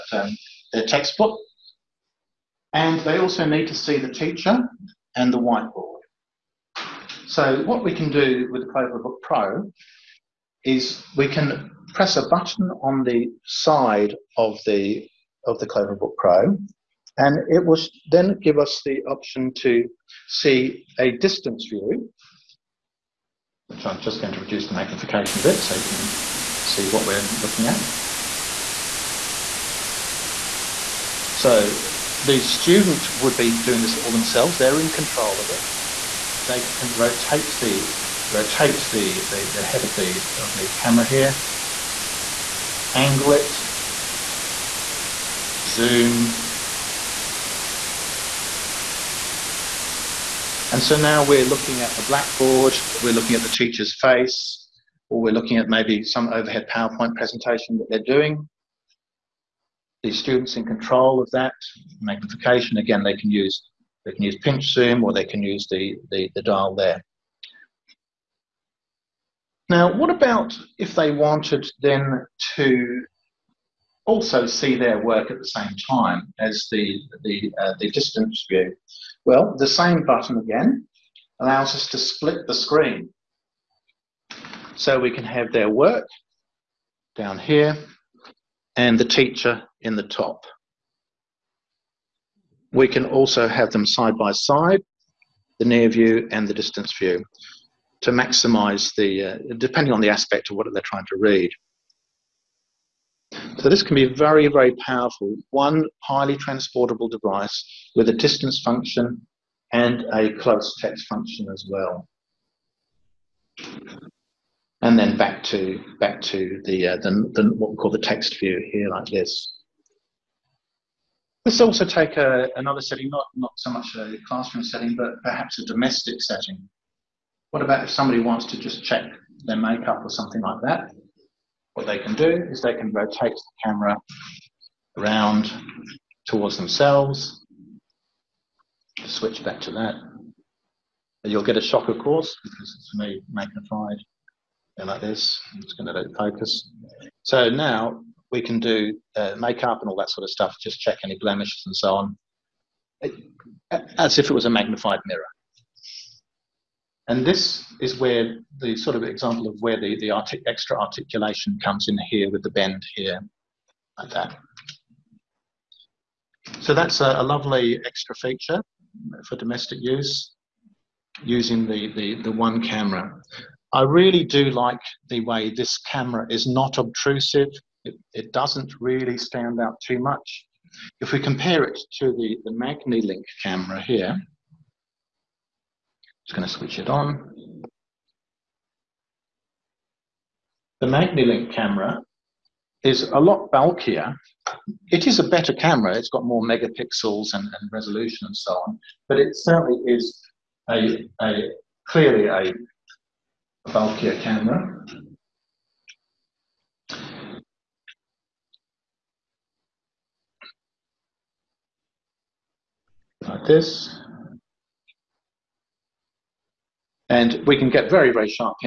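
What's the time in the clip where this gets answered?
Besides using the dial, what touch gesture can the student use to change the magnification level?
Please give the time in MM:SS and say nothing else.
01:04.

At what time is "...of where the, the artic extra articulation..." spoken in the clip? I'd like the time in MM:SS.
02:39.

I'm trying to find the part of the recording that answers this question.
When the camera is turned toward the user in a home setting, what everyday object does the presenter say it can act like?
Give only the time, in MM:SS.
02:34.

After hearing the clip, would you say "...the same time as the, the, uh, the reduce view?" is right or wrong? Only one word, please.
wrong.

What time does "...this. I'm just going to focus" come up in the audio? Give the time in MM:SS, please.
02:25.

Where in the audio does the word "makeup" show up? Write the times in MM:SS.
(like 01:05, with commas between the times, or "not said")
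02:09, 02:29.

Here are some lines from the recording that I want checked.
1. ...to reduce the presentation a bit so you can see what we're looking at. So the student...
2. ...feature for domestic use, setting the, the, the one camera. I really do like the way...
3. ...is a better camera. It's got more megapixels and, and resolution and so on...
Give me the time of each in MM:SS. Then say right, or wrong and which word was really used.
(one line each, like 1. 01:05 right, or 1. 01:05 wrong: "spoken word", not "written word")
1. 00:24 wrong: "magnification", not "presentation"
2. 02:48 wrong: "using", not "setting"
3. 03:15 right.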